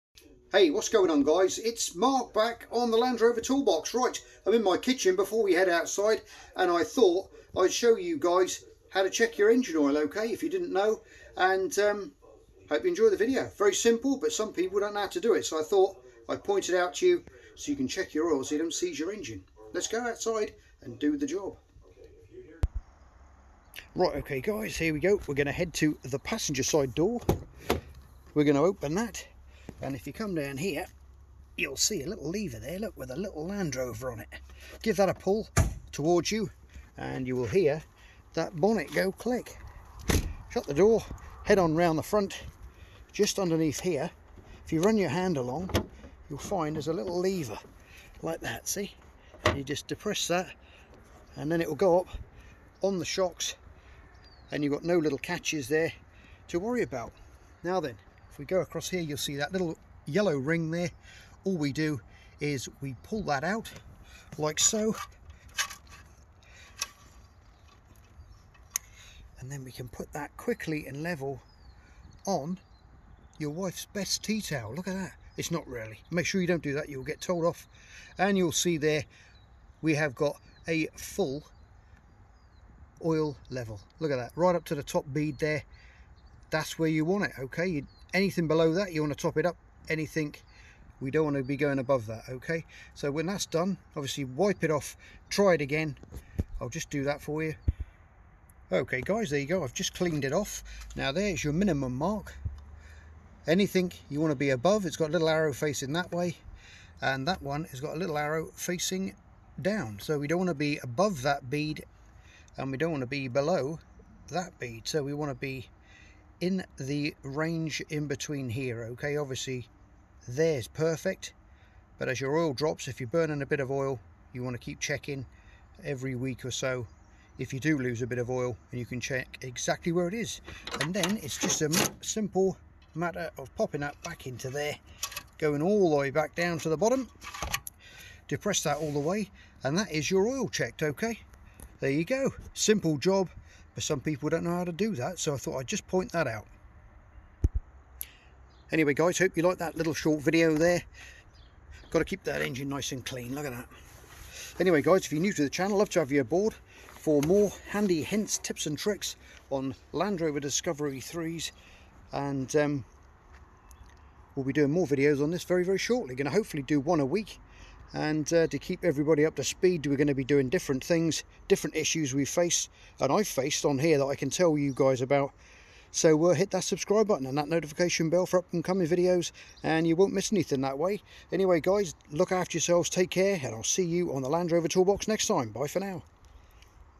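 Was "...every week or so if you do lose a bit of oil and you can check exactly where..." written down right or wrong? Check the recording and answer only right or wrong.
right.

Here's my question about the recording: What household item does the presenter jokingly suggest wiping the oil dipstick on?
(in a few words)
Wife's best tea towel.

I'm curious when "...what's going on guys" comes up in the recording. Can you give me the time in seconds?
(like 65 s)
0 s.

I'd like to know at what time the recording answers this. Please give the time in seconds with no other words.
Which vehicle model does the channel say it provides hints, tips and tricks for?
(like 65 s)
159 s.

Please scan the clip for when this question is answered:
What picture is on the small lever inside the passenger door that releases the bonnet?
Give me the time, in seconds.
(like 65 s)
33 s.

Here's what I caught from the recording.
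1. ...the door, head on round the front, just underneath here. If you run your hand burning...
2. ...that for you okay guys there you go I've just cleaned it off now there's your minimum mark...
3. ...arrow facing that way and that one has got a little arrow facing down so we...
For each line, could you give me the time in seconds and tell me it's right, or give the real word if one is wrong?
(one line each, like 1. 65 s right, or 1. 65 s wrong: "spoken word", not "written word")
1. 40 s wrong: "along", not "burning"
2. 97 s right
3. 105 s right.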